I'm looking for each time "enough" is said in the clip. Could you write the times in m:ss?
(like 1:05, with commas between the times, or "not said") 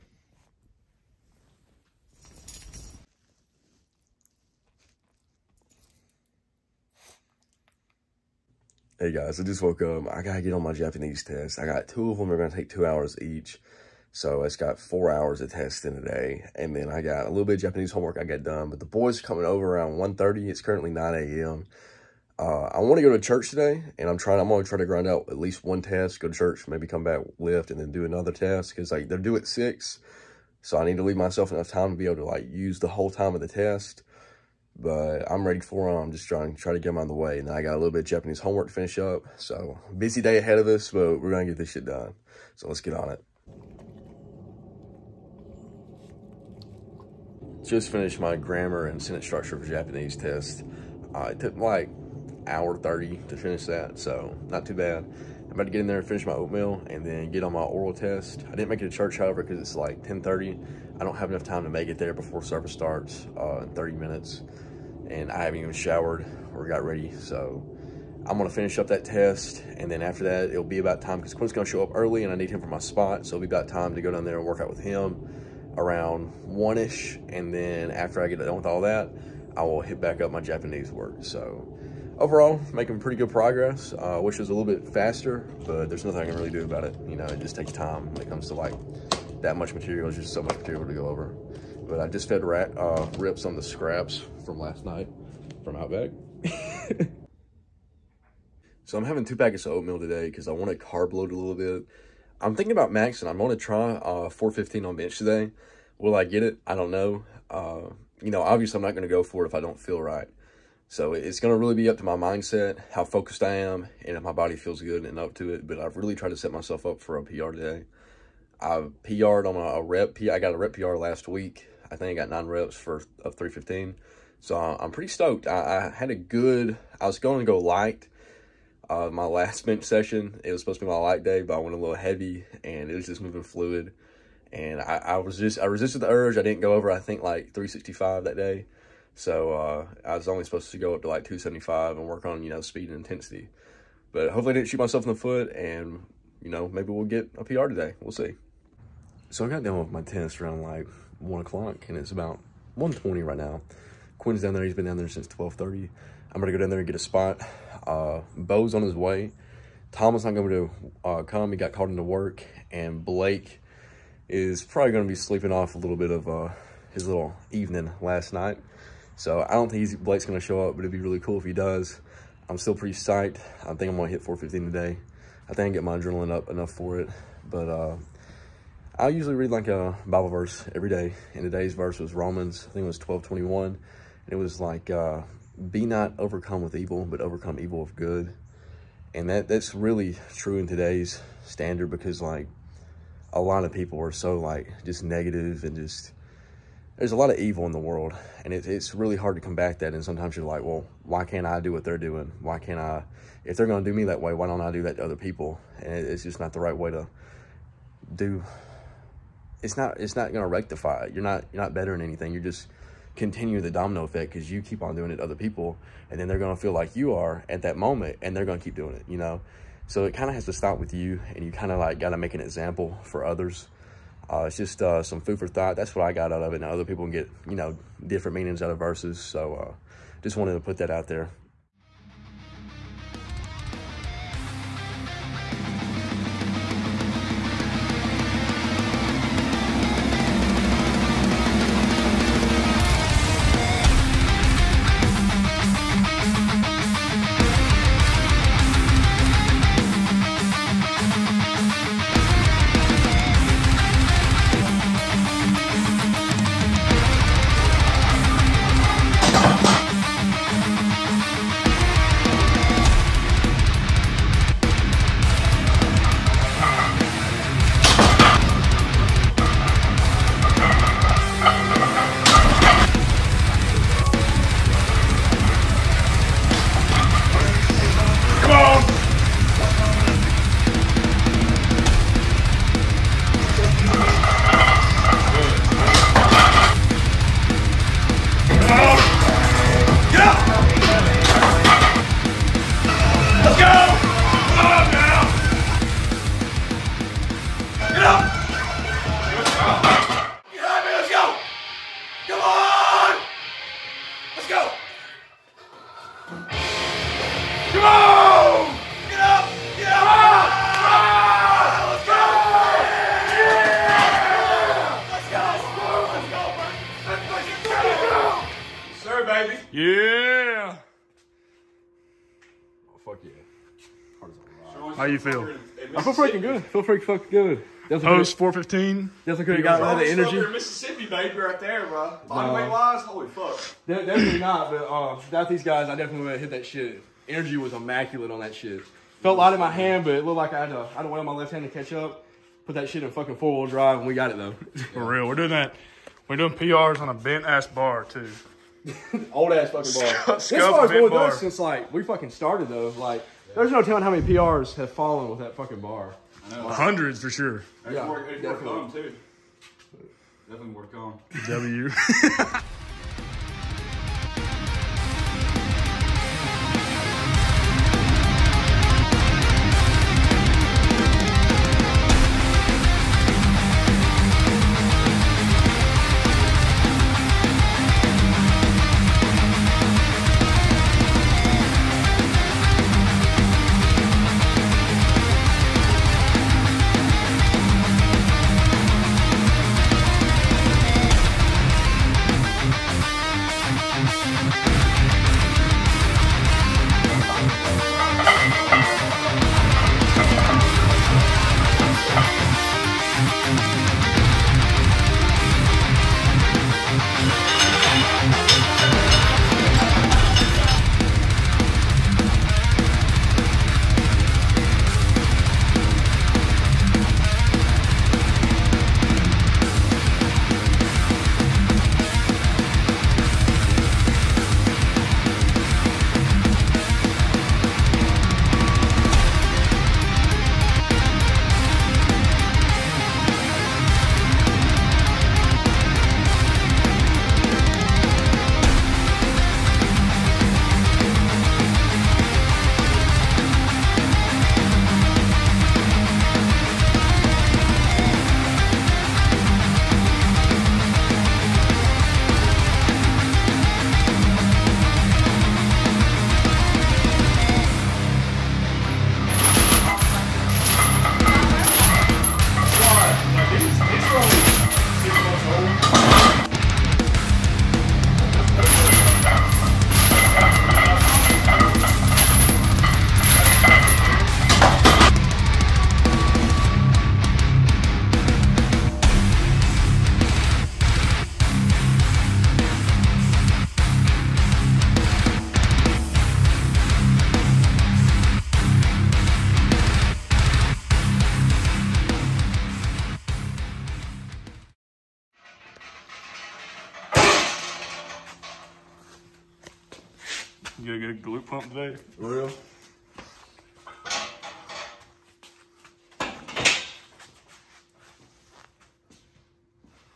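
0:31, 1:01, 2:56.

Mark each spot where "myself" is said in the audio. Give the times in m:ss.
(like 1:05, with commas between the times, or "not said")
0:31, 1:56, 2:24.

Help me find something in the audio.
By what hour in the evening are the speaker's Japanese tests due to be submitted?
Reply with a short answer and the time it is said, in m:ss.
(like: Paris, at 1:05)
6, at 0:29.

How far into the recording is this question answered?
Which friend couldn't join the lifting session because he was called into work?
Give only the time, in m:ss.
2:39.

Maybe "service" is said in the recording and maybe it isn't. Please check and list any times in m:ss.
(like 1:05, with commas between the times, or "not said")
1:02.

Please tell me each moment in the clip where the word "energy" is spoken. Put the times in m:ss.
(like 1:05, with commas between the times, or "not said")
5:30, 5:37.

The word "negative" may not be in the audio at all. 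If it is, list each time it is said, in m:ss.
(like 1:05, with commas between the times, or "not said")
3:15.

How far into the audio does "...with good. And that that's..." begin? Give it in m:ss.
3:07.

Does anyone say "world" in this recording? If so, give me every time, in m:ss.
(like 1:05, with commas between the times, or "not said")
3:17.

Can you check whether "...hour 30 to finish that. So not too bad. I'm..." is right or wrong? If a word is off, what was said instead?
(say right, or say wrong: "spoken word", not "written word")
right.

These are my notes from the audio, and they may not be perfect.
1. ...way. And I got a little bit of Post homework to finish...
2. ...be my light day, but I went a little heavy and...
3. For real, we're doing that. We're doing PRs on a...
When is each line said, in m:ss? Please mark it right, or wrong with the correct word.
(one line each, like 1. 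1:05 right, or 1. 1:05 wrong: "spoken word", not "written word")
1. 0:37 wrong: "Japanese", not "Post"
2. 2:10 right
3. 5:44 right.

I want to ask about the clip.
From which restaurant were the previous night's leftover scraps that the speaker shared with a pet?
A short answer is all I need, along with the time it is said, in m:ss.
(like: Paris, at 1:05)
Outback, at 1:35.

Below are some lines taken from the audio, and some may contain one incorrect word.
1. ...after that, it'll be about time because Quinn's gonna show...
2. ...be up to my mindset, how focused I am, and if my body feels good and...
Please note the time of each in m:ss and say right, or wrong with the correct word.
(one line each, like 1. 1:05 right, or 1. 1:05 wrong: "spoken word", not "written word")
1. 1:10 right
2. 1:51 right.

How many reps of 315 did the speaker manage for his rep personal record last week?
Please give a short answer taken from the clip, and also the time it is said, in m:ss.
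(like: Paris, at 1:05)
9, at 2:02.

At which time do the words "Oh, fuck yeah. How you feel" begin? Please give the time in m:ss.
5:22.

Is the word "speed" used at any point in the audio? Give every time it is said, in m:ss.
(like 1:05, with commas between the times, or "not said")
2:22.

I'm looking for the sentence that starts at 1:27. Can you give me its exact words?
You know, it just takes time when it comes to like that much material.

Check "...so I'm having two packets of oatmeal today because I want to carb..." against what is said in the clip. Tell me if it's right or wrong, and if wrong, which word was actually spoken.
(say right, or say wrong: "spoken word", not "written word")
right.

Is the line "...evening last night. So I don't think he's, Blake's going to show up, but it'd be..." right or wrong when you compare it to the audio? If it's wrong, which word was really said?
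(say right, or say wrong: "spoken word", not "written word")
right.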